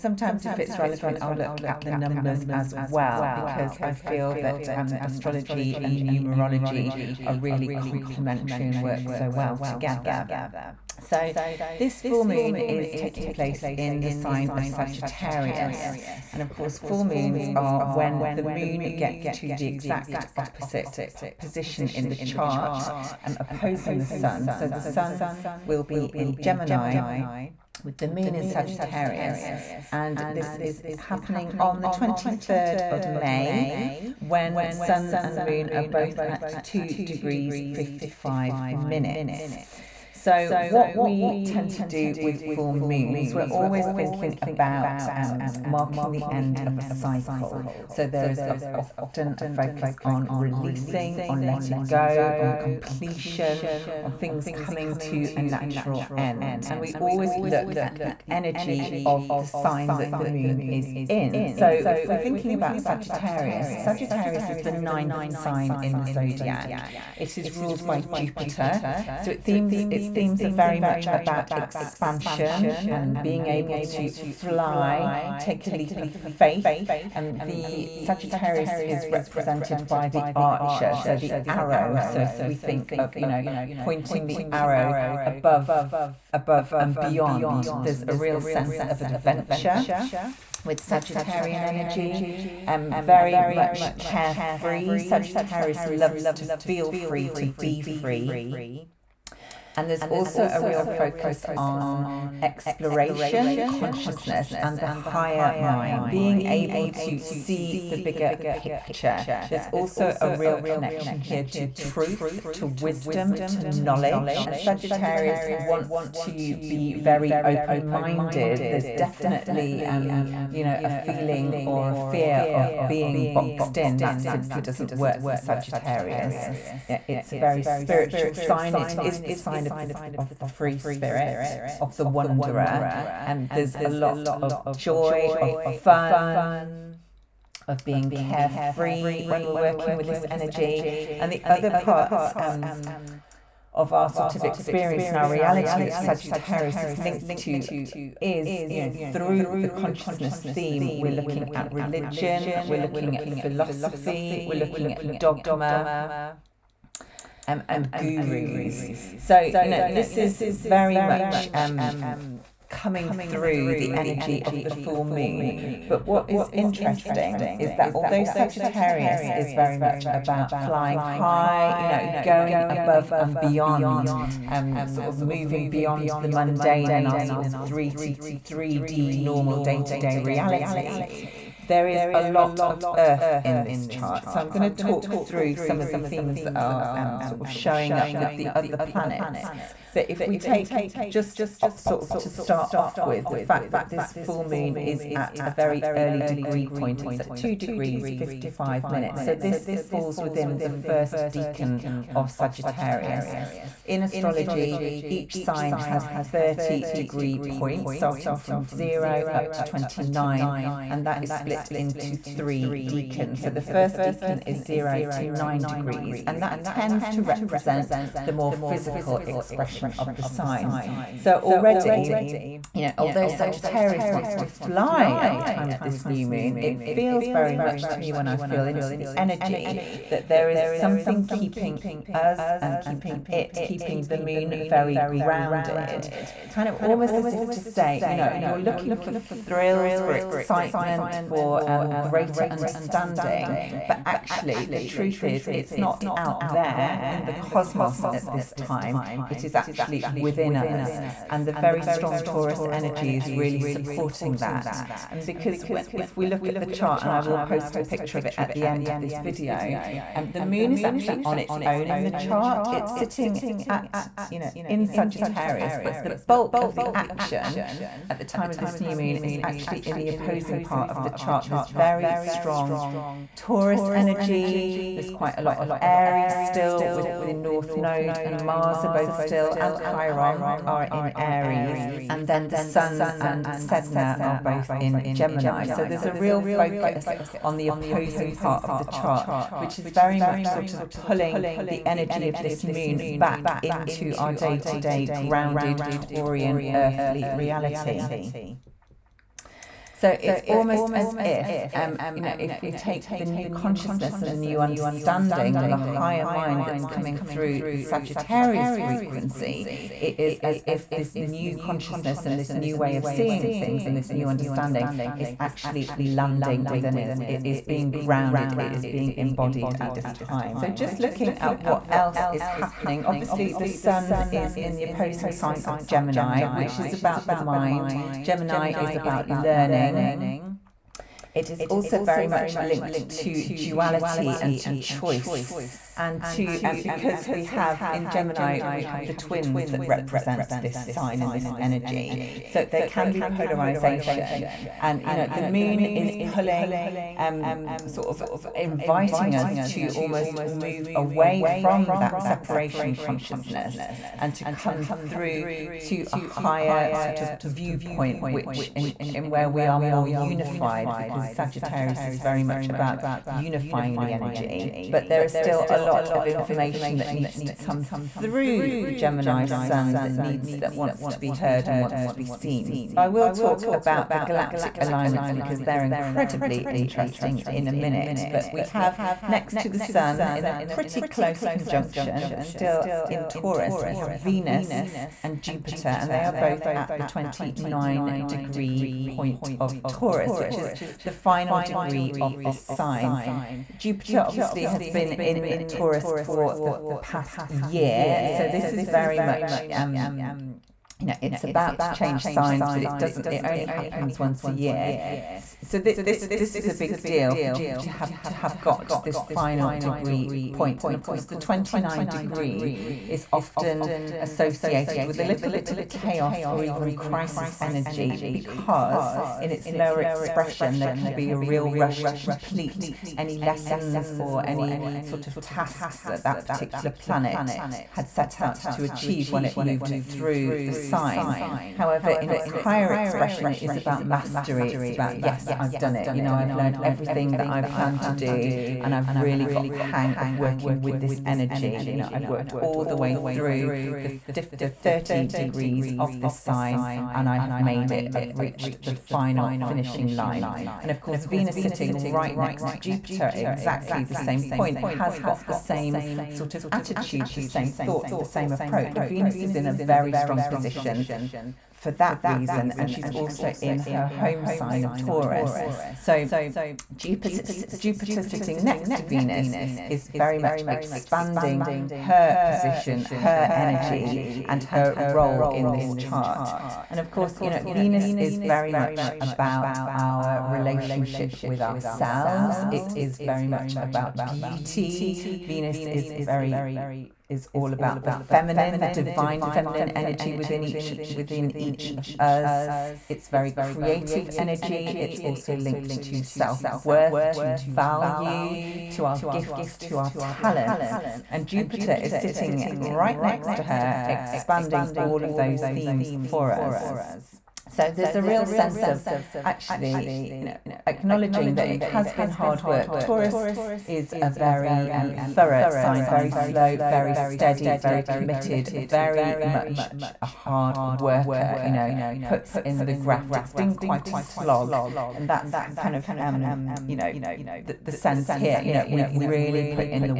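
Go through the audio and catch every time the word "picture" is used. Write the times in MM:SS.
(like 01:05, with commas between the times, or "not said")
01:48, 04:17.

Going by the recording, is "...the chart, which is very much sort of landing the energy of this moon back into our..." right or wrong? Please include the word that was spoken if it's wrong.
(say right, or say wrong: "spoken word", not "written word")
wrong: "pulling", not "landing".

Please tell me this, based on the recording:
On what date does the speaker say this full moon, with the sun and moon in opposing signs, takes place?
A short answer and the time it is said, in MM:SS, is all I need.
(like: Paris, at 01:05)
23rd of May, at 00:31.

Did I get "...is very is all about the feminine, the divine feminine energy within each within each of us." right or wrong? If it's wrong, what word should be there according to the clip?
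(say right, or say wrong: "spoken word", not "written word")
right.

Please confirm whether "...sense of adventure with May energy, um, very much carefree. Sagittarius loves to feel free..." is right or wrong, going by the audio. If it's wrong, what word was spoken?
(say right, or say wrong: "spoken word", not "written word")
wrong: "Sagittarian", not "May".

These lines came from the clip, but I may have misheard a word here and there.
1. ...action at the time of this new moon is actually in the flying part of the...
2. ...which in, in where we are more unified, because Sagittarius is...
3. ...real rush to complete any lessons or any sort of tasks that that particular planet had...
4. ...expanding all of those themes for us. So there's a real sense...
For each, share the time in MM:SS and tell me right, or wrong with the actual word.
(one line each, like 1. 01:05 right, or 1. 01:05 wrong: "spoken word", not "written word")
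1. 04:26 wrong: "opposing", not "flying"
2. 05:58 right
3. 07:01 right
4. 08:24 right.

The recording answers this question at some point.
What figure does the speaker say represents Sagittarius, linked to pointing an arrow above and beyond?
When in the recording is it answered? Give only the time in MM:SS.
01:20.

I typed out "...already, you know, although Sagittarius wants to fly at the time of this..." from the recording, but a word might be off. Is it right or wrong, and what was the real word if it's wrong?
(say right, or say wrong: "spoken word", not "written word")
right.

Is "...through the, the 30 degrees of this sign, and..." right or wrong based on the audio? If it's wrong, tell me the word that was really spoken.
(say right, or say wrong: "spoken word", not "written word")
right.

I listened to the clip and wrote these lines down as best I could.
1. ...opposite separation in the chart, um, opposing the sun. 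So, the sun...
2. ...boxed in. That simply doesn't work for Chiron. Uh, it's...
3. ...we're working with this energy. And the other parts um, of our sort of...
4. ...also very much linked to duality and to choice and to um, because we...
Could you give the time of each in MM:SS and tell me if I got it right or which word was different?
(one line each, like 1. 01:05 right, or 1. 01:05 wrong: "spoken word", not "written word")
1. 00:20 wrong: "position", not "separation"
2. 02:03 wrong: "Sagittarius", not "Chiron"
3. 02:19 right
4. 05:31 right.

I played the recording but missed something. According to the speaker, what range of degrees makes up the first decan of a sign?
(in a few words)
0 to 9 degrees.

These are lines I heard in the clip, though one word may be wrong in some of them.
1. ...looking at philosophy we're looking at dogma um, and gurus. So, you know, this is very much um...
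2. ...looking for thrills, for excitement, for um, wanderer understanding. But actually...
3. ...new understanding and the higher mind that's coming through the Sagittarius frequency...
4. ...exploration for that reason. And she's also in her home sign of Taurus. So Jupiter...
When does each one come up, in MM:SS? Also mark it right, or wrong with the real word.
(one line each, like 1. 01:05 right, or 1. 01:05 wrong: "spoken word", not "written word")
1. 02:32 right
2. 03:58 wrong: "greater", not "wanderer"
3. 05:04 right
4. 07:40 wrong: "position", not "exploration".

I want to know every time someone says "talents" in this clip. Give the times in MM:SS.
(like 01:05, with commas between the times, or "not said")
08:20.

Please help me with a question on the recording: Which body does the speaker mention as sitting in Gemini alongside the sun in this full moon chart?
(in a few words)
Sedna.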